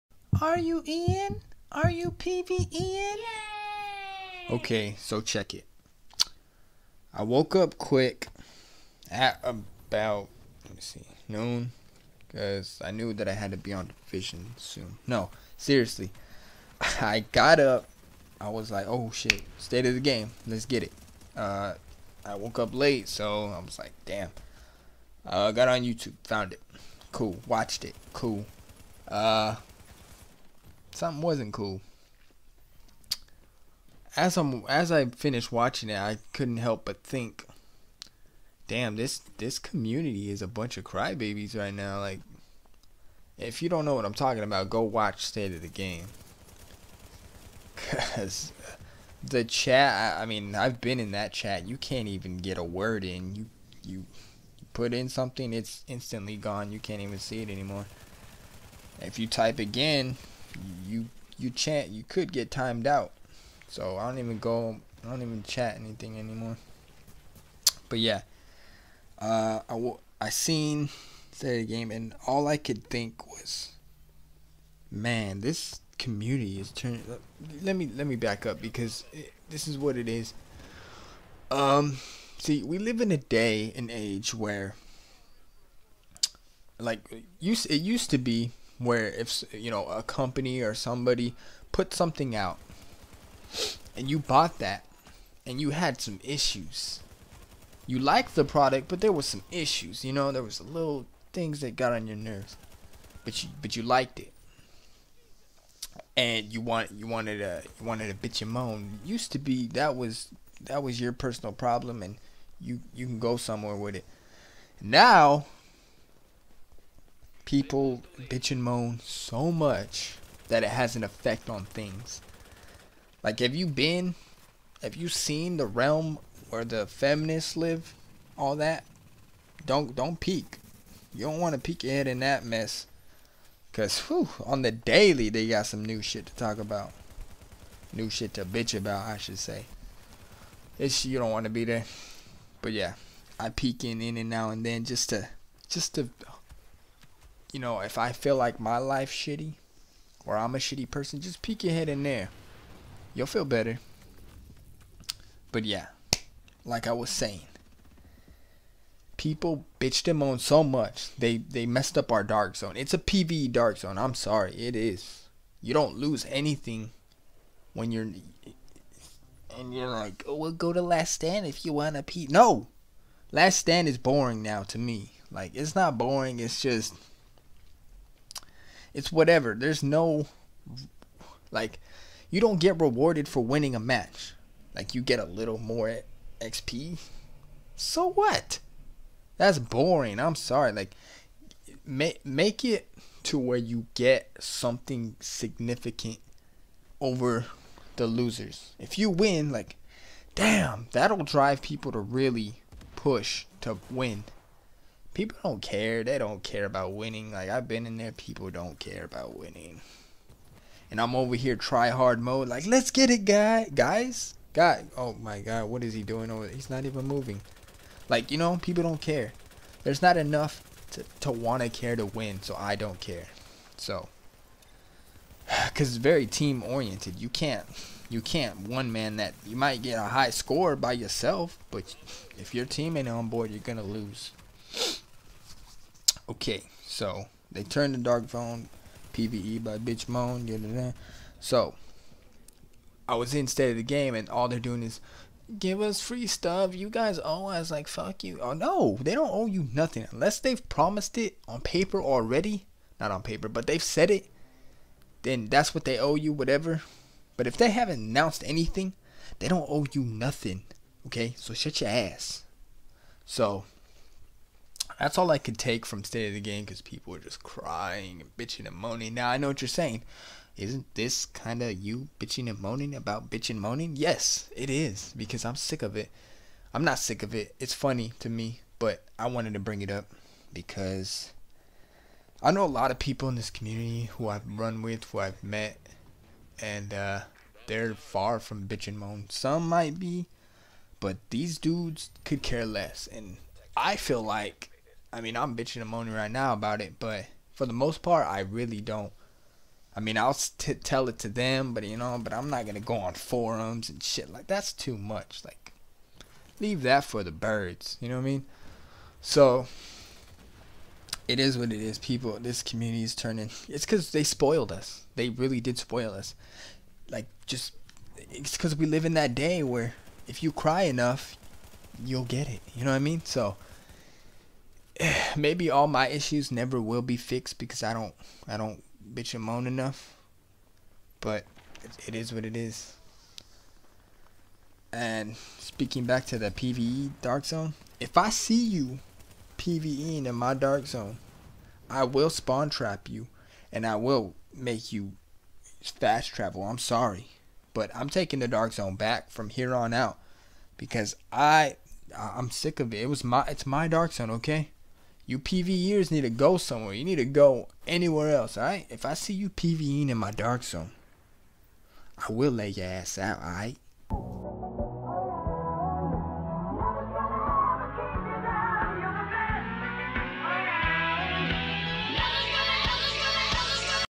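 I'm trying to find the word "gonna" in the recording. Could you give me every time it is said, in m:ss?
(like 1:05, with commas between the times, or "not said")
3:53, 5:02.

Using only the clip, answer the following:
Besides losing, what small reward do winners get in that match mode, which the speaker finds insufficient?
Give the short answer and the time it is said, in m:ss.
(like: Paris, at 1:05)
A little more XP, at 3:05.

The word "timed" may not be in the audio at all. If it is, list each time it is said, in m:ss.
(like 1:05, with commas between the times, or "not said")
1:02.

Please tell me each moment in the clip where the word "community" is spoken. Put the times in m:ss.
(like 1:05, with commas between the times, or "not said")
0:39, 1:15, 4:43, 5:12.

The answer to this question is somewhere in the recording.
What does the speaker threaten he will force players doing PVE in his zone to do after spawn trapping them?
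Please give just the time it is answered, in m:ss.
5:45.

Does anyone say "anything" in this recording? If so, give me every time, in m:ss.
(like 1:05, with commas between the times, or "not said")
1:05, 2:46, 4:18.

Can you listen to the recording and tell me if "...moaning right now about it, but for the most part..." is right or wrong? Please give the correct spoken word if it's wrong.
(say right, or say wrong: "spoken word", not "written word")
right.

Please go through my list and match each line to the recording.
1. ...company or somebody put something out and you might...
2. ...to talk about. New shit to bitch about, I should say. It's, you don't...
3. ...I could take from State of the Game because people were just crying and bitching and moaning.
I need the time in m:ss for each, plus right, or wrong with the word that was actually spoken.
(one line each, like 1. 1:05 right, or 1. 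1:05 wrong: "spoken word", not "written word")
1. 1:30 wrong: "bought", not "might"
2. 2:16 right
3. 4:25 right.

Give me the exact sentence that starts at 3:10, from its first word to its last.
Like make make it to where you get something significant over the losers.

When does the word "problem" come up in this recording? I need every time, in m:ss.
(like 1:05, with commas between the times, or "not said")
1:51.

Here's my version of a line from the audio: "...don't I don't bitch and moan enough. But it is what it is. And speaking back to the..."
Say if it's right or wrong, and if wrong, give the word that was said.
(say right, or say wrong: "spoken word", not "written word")
right.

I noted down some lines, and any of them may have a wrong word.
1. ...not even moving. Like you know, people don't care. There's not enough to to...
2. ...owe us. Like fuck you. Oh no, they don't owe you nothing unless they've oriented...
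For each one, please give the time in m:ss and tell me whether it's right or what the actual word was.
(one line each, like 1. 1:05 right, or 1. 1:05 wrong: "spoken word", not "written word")
1. 3:36 right
2. 4:07 wrong: "promised", not "oriented".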